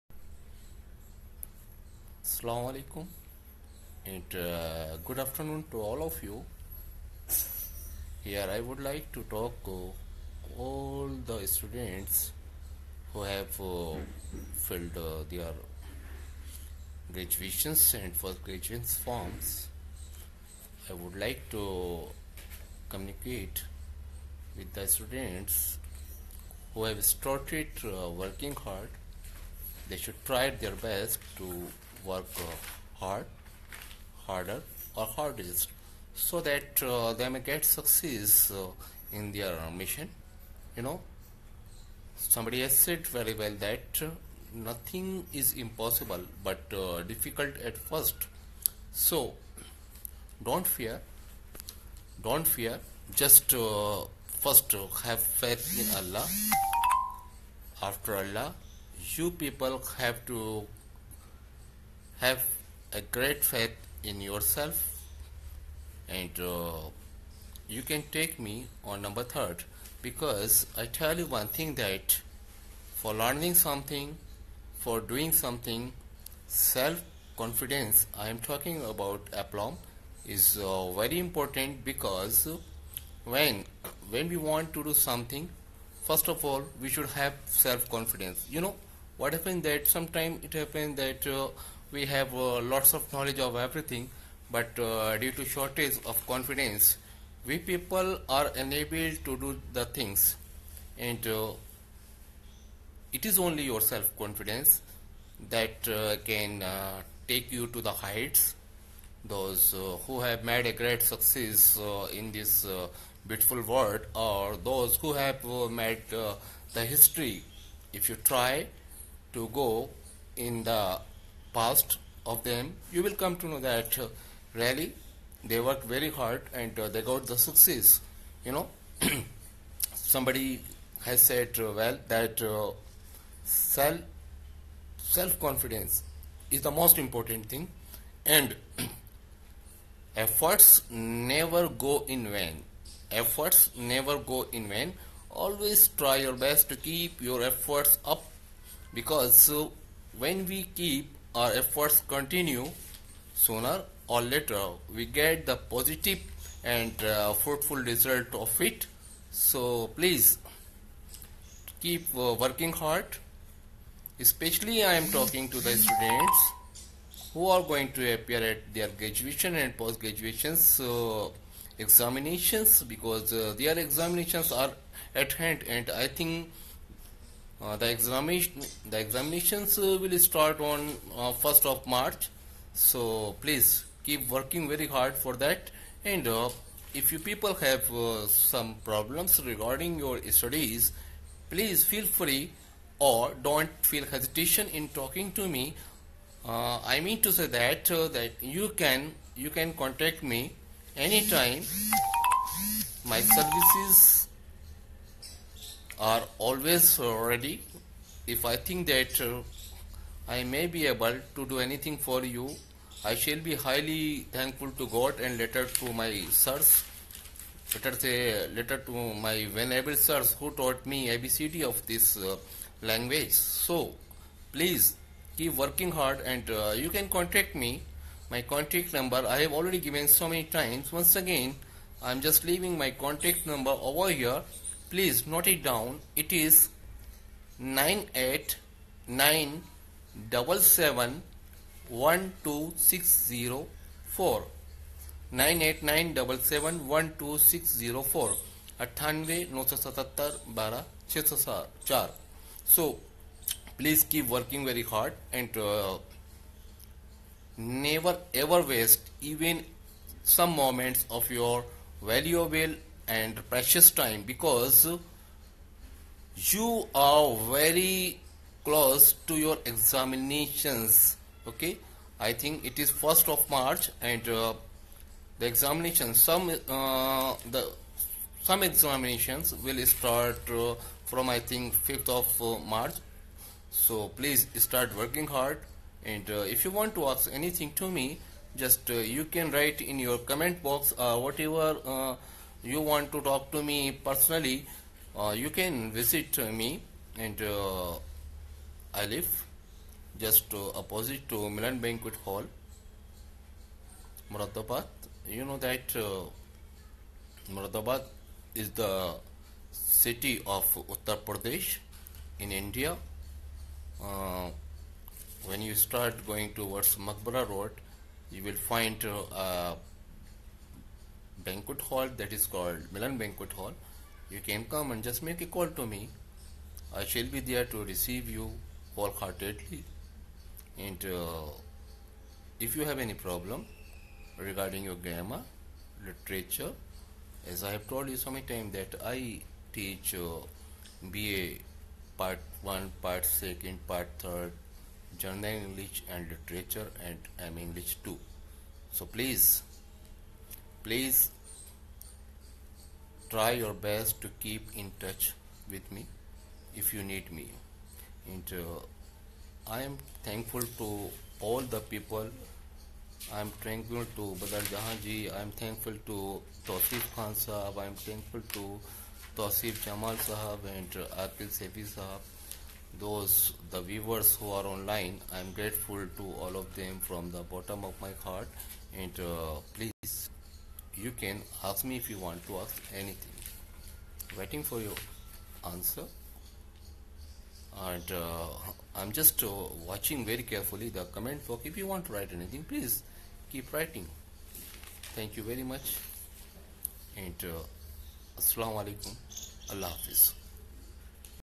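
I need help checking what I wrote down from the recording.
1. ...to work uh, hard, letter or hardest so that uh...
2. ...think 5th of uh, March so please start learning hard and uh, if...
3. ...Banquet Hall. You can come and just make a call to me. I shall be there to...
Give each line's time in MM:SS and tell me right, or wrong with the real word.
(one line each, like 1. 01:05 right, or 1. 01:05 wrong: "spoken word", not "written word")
1. 00:31 wrong: "harder", not "letter"
2. 04:41 wrong: "working", not "learning"
3. 05:23 right.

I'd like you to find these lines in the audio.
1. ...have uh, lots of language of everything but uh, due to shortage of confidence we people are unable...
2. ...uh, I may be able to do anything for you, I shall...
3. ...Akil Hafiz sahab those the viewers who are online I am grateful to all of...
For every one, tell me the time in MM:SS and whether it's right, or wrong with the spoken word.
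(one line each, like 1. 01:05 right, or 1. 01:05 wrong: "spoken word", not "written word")
1. 01:32 wrong: "knowledge", not "language"
2. 03:29 right
3. 06:11 wrong: "Sefi", not "Hafiz".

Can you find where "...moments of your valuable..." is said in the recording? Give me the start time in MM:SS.
04:20.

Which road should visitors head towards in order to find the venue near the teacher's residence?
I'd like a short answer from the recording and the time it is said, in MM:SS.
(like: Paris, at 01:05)
Makbara Road, at 05:16.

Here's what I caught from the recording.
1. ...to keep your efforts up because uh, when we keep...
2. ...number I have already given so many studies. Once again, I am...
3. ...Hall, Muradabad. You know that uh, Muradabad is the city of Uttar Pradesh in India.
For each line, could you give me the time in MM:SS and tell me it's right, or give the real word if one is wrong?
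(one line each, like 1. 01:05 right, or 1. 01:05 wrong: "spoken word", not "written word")
1. 02:26 right
2. 03:48 wrong: "times", not "studies"
3. 05:02 right.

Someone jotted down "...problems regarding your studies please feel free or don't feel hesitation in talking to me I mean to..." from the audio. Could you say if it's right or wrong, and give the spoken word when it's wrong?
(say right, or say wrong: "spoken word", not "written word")
right.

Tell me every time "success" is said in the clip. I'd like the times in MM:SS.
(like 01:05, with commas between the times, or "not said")
00:37, 01:51, 02:07.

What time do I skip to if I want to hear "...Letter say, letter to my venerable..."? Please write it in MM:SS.
03:37.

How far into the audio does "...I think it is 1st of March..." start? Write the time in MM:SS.
04:32.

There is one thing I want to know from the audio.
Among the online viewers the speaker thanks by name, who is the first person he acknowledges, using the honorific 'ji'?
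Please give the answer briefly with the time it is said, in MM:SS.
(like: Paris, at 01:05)
Badal Jahan, at 06:04.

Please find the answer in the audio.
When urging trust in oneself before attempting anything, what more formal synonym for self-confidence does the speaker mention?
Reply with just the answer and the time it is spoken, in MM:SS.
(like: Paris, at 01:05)
aplomb, at 01:19.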